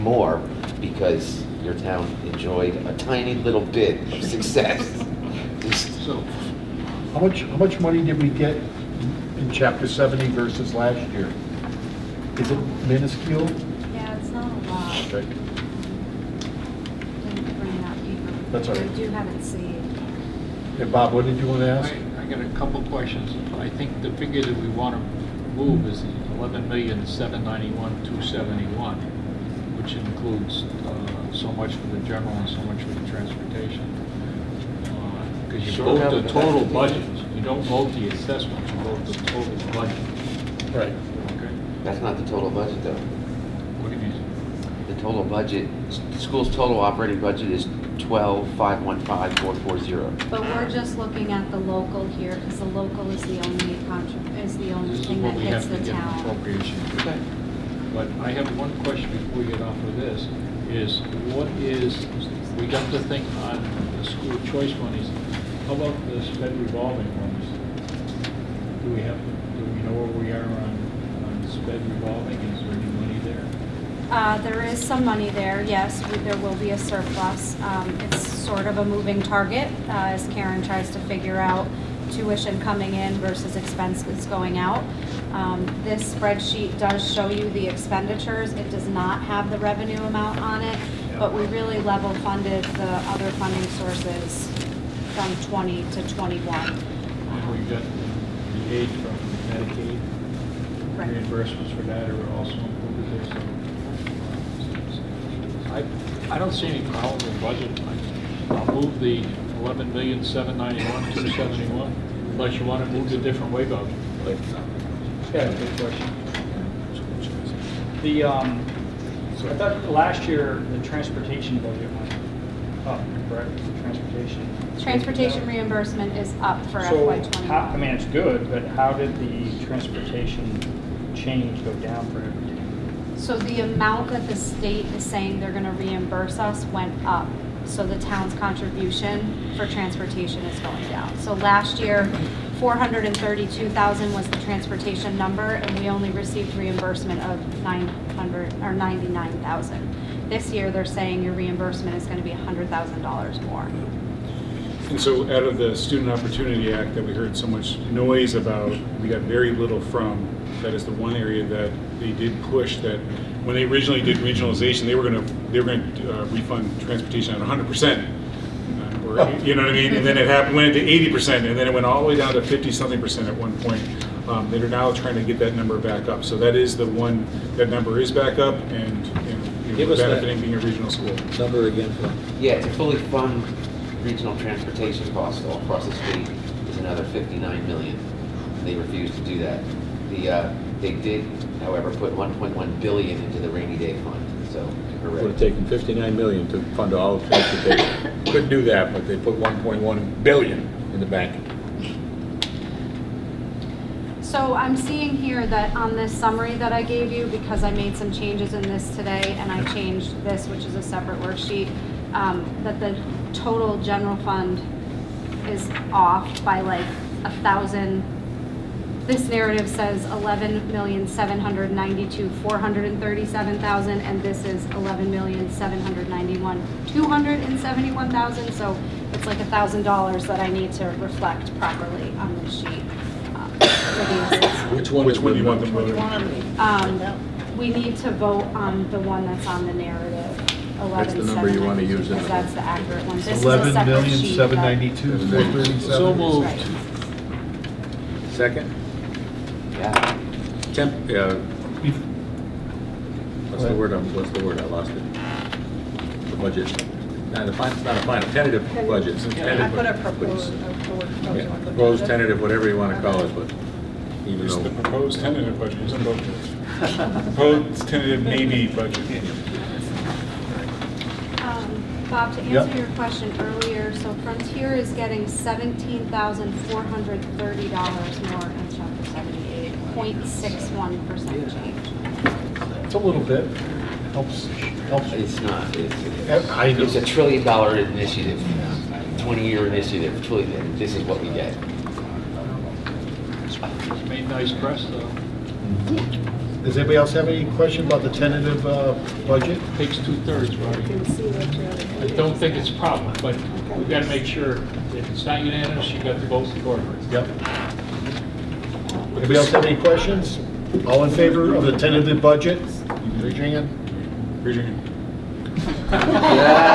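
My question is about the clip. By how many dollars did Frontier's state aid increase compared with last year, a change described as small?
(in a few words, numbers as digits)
$17,430.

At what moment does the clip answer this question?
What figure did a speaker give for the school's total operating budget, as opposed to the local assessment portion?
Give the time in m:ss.
0:47.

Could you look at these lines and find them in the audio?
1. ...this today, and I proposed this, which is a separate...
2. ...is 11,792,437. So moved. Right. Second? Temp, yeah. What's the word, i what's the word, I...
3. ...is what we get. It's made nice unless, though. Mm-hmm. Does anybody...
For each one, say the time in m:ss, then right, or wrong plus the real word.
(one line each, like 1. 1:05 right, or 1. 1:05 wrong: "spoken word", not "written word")
1. 3:28 wrong: "changed", not "proposed"
2. 4:03 right
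3. 4:50 wrong: "press", not "unless".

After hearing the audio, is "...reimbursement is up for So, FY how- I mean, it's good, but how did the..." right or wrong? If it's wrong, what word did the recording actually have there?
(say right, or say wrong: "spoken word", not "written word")
right.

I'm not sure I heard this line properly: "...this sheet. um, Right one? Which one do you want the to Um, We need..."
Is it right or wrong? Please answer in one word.
wrong.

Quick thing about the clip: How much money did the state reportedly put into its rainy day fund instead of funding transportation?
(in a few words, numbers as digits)
1.1 billion.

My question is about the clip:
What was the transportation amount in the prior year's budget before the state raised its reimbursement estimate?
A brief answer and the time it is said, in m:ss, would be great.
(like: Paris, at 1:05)
432,000, at 2:22.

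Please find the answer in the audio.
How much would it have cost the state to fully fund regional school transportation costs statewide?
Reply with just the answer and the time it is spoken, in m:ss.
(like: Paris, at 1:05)
59 million, at 3:06.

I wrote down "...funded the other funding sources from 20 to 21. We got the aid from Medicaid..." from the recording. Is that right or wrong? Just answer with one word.
right.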